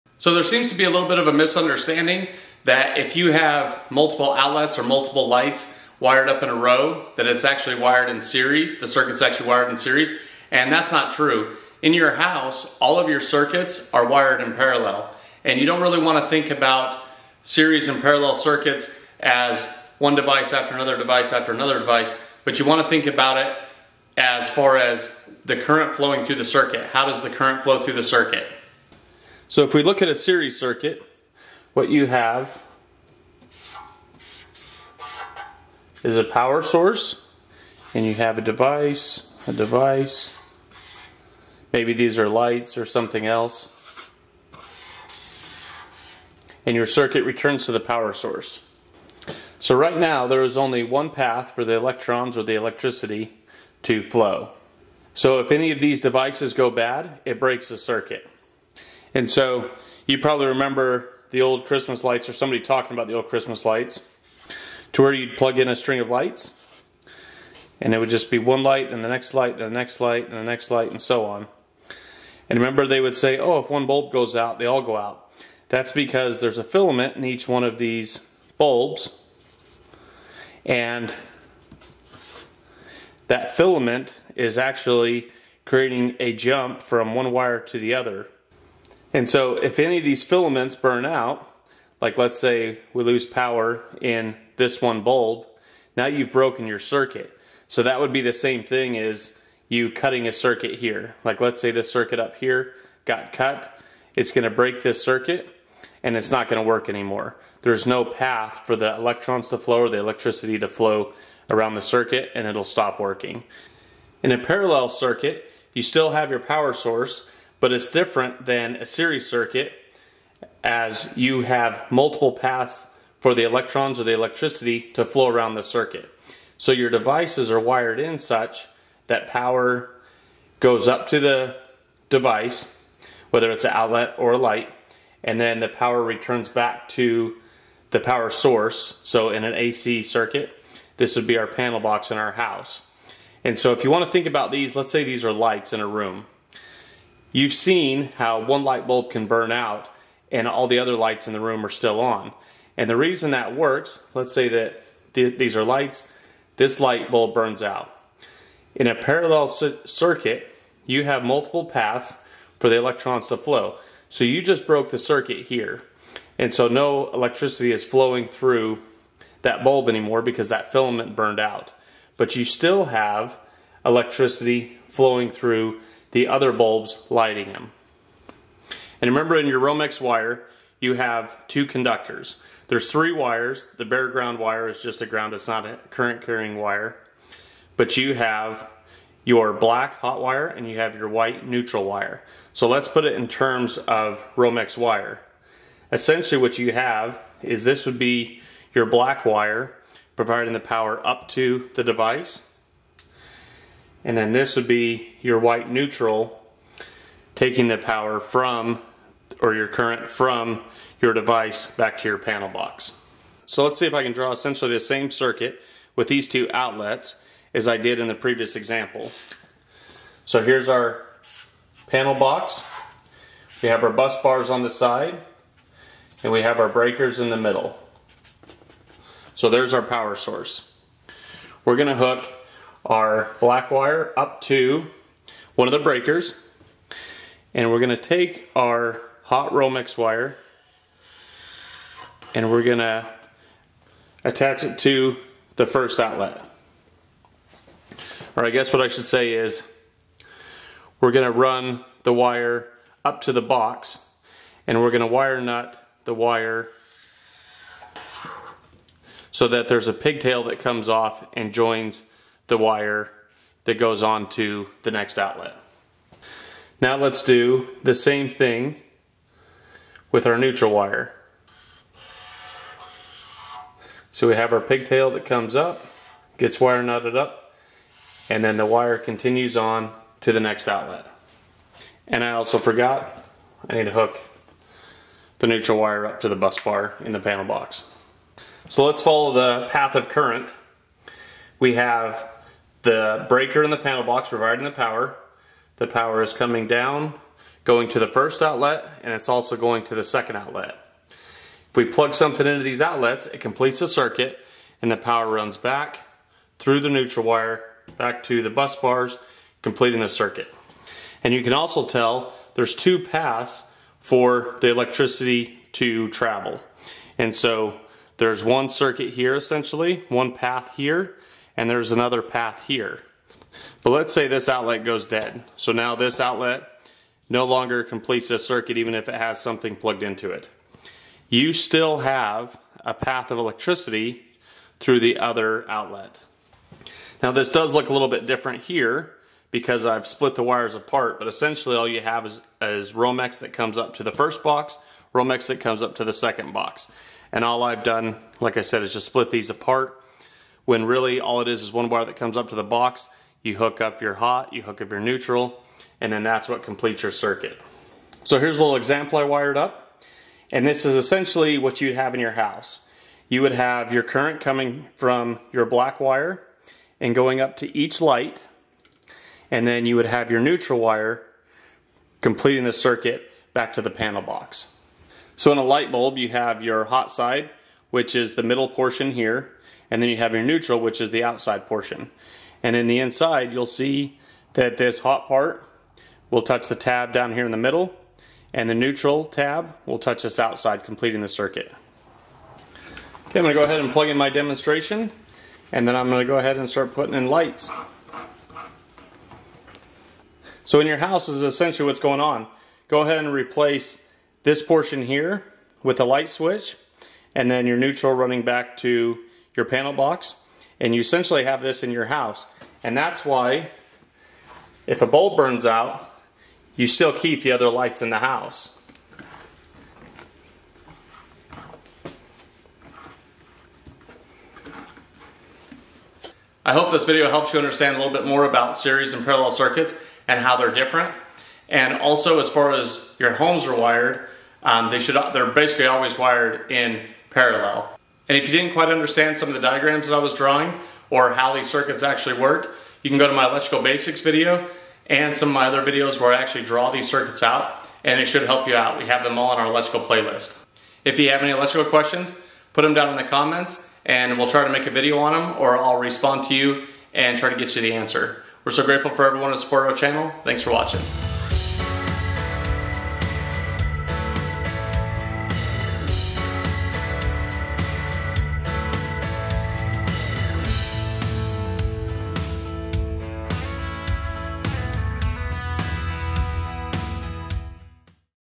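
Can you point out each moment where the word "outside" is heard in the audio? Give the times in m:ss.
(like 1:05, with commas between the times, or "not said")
6:21, 6:30.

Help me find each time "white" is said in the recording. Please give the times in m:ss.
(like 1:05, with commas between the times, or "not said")
3:11, 3:25.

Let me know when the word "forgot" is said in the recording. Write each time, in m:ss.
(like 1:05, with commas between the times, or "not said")
4:42.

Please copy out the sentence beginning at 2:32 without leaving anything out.
And the reason that works, let's say that th these are lights, this light bulb burns out.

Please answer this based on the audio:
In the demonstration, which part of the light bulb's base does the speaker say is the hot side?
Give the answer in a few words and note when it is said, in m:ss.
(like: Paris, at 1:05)
the middle portion, at 6:18.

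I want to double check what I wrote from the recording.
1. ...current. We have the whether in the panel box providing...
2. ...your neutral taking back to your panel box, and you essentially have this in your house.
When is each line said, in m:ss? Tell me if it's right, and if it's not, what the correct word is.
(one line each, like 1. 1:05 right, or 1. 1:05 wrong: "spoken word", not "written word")
1. 4:50 wrong: "breaker", not "whether"
2. 6:47 wrong: "running", not "taking".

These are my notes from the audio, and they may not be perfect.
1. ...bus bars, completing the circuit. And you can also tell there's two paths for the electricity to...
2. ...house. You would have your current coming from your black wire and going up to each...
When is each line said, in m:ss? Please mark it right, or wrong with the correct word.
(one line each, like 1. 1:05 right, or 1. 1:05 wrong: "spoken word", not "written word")
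1. 5:08 right
2. 6:02 right.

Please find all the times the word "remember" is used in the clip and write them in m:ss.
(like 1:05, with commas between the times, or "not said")
1:00, 1:12, 2:59.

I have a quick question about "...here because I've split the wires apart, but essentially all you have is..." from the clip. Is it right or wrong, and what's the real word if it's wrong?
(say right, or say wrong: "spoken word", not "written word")
right.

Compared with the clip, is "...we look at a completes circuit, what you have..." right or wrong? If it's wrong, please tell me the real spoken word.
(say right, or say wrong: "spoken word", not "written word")
wrong: "series", not "completes".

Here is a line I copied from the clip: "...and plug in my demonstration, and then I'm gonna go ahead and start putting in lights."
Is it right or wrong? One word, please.
right.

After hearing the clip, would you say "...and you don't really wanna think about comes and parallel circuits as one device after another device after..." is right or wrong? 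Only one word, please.
wrong.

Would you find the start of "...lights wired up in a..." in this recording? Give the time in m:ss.
0:05.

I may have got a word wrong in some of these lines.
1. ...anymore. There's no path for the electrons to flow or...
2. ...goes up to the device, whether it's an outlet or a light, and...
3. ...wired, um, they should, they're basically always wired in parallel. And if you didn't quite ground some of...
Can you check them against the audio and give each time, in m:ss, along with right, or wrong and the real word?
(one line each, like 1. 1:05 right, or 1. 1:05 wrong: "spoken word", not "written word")
1. 1:46 right
2. 2:10 right
3. 7:13 wrong: "understand", not "ground".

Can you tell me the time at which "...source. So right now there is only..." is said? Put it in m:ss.
0:48.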